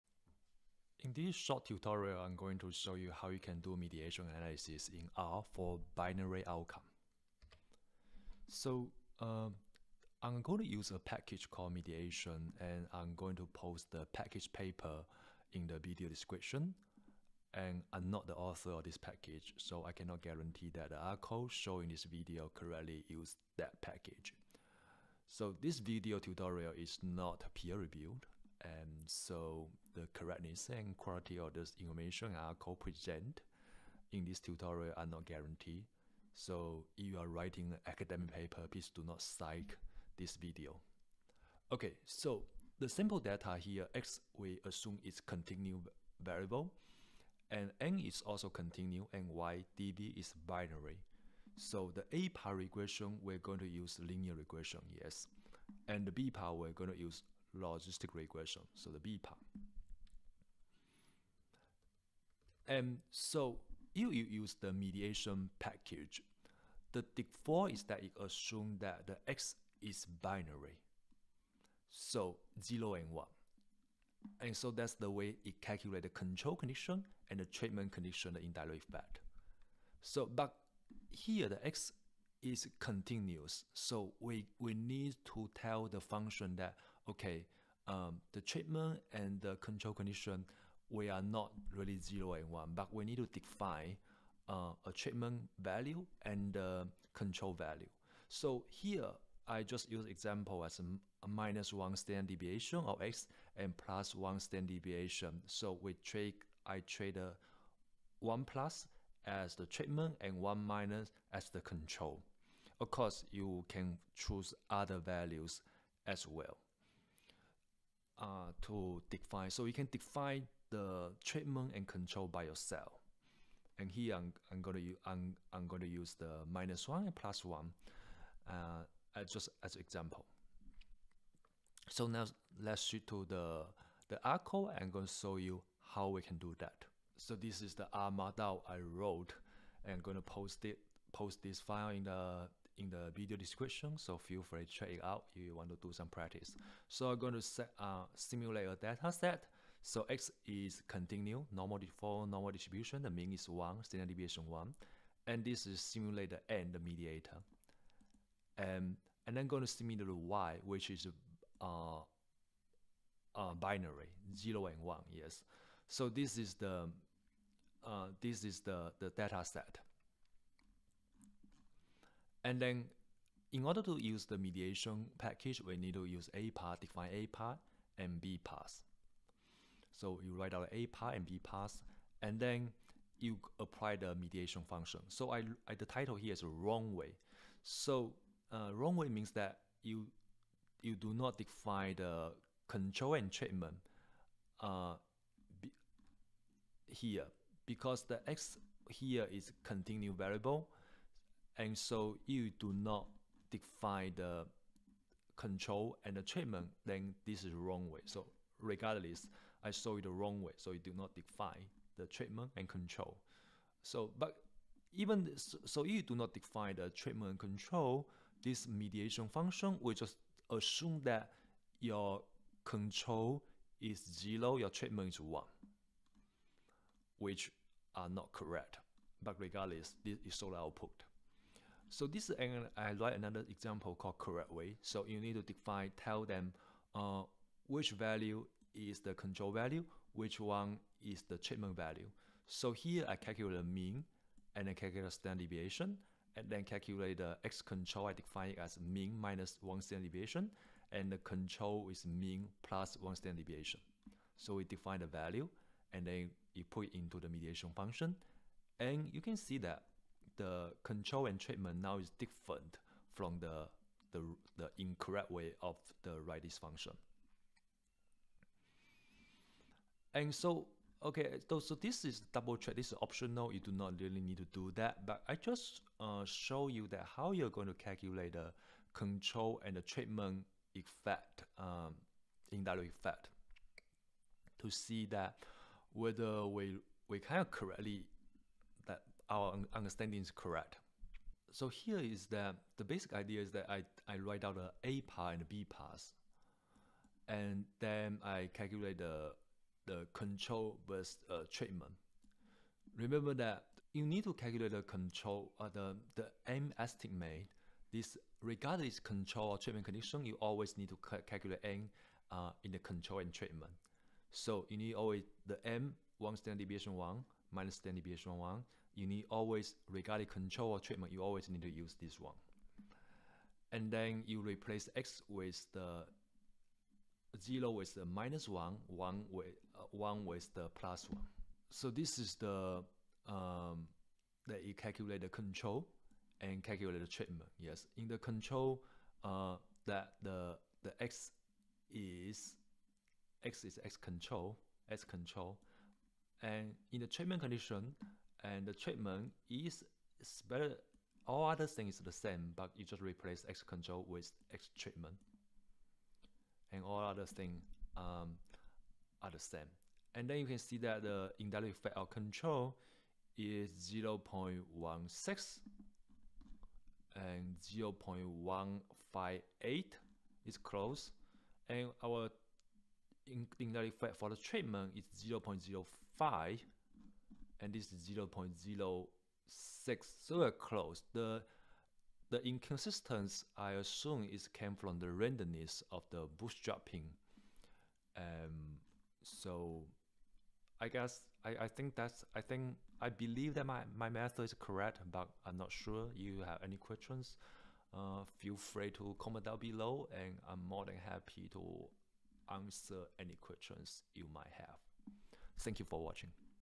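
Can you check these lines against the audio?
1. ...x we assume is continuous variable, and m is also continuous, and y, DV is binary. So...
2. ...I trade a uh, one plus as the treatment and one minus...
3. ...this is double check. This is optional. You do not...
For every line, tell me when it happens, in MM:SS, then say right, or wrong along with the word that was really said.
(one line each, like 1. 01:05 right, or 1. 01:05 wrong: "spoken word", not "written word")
1. 00:43 right
2. 01:46 right
3. 04:31 right.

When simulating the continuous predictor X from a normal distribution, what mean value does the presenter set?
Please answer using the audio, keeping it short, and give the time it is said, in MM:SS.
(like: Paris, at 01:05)
1, at 02:33.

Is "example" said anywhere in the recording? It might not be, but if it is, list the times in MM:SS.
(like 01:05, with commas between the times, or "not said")
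01:40, 02:09, 03:53.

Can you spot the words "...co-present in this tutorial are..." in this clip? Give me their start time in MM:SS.
00:32.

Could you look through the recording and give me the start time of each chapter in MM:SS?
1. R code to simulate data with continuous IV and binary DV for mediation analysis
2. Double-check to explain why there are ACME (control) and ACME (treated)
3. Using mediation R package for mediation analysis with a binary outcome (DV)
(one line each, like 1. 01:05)
1. 02:16
2. 04:29
3. 02:53.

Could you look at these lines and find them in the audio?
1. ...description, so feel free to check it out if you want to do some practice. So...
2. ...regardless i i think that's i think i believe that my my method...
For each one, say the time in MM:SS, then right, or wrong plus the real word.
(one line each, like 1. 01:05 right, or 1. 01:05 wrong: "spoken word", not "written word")
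1. 02:23 right
2. 06:30 wrong: "guess", not "regardless".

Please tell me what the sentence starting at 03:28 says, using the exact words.
So regardless, I saw it the wrong way.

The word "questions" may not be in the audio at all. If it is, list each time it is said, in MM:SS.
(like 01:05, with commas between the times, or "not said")
06:36, 06:43.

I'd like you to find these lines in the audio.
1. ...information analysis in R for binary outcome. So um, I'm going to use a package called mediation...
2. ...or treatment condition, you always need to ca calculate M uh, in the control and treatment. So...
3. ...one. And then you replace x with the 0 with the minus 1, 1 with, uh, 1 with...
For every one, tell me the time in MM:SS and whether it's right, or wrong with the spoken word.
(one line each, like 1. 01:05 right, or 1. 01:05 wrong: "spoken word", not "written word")
1. 00:03 wrong: "mediation", not "information"
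2. 05:09 right
3. 05:22 right.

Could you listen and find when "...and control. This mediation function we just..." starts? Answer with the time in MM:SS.
03:37.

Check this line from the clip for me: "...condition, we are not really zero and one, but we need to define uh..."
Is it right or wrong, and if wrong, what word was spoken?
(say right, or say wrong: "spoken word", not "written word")
right.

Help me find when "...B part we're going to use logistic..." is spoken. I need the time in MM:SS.
00:56.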